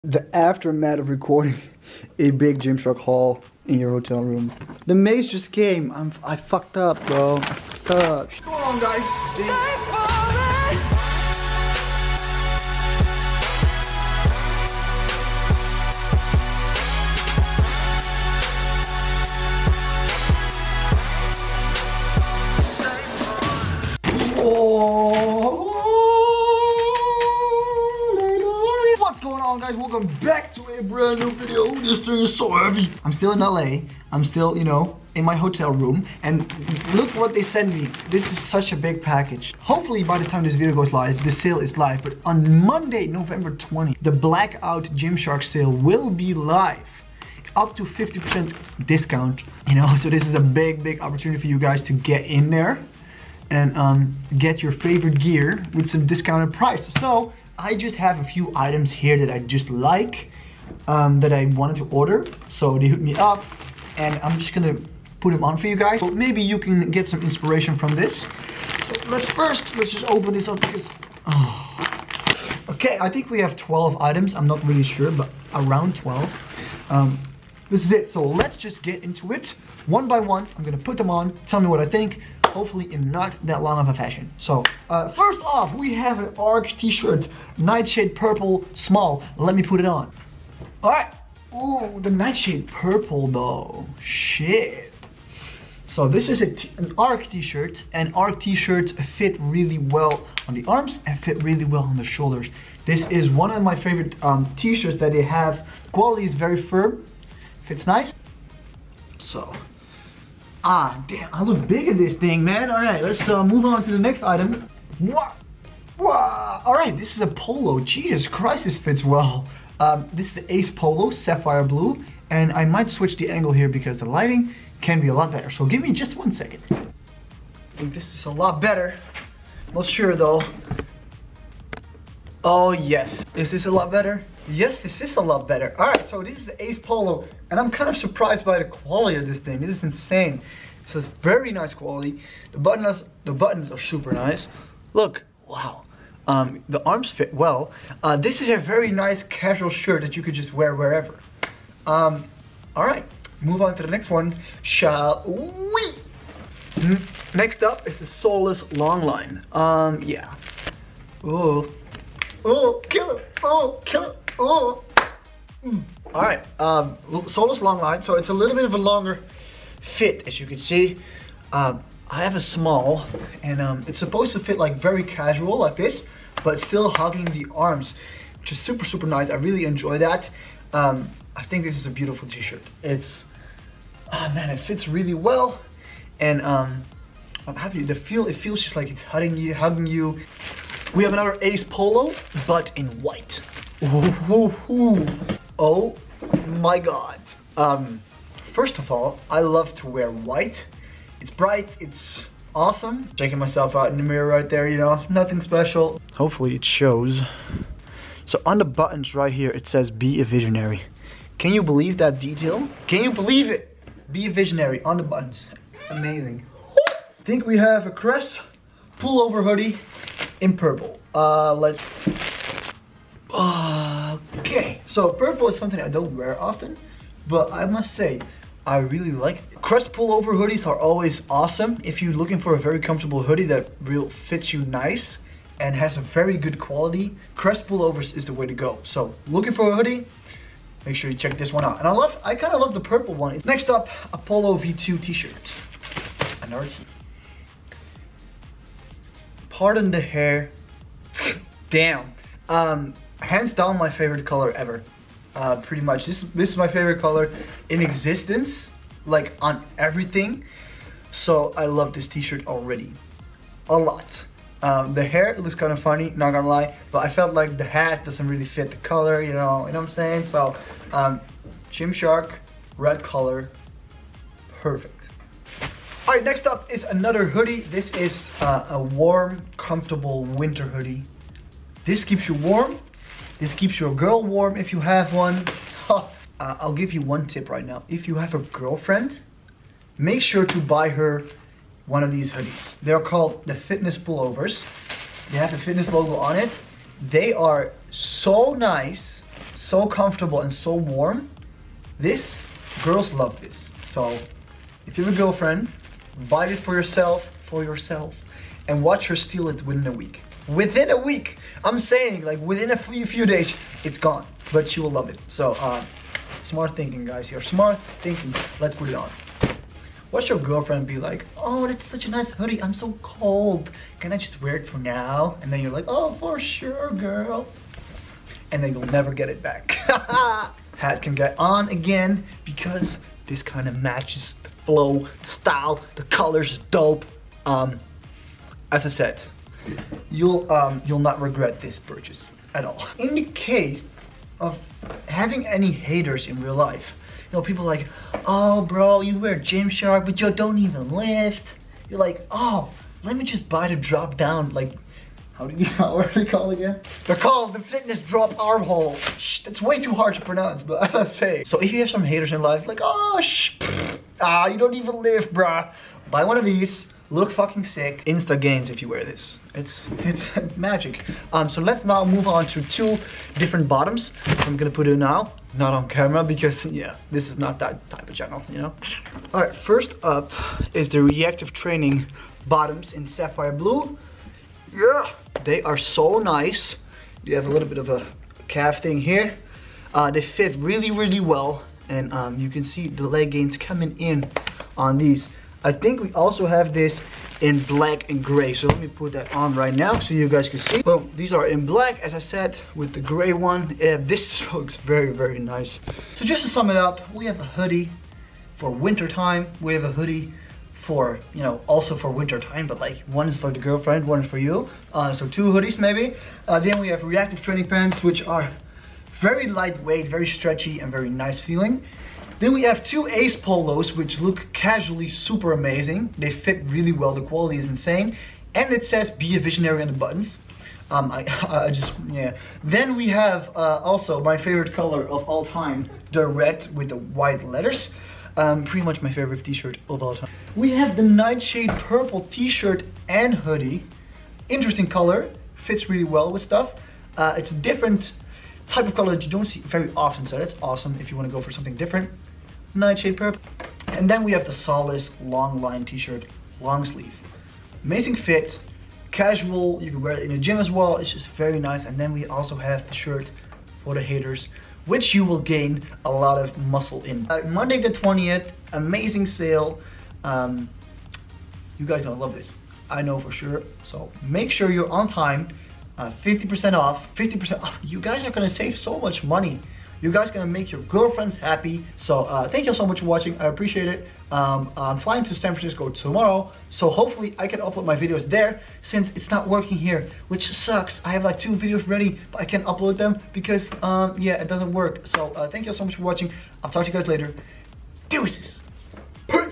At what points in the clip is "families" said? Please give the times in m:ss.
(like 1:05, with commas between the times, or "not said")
not said.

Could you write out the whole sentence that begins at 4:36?
All right, next up is another hoodie.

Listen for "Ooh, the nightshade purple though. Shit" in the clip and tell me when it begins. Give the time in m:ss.
1:31.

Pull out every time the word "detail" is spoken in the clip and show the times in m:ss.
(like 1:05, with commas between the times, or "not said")
3:32.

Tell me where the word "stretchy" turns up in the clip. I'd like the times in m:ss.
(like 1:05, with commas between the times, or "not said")
7:00.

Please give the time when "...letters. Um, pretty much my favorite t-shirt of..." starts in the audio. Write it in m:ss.
7:17.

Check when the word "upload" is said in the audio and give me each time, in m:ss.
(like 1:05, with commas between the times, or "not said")
8:07, 8:12.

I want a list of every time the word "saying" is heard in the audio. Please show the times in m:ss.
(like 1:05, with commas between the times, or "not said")
4:29, 5:11.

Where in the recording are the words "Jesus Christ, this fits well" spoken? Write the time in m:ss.
1:57.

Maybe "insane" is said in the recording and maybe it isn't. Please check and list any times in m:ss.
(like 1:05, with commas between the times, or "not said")
2:19, 7:07.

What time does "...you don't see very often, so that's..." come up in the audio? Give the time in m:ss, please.
7:29.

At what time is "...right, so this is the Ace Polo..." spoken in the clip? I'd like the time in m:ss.
2:15.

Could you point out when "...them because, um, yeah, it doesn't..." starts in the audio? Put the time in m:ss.
8:12.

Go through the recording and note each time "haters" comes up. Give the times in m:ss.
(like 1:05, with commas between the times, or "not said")
5:45, 6:02, 7:44.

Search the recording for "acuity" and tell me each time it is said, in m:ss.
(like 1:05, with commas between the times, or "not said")
not said.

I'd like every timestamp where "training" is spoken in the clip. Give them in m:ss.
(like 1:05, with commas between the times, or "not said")
6:21, 6:57.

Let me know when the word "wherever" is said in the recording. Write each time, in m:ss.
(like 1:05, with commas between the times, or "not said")
2:30.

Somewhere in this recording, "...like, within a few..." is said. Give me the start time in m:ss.
5:12.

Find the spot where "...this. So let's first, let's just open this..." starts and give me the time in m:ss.
1:07.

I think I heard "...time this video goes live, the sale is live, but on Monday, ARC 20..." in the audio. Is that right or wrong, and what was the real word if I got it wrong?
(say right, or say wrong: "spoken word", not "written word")
wrong: "November", not "ARC".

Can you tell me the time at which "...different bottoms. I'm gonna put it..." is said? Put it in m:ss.
6:13.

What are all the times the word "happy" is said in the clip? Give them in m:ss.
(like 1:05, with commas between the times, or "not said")
3:07, 8:01.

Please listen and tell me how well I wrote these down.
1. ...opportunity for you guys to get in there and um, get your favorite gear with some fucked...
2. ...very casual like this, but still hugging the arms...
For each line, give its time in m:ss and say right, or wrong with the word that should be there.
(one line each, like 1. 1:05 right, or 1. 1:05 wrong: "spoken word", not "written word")
1. 0:51 wrong: "discounted", not "fucked"
2. 2:54 right.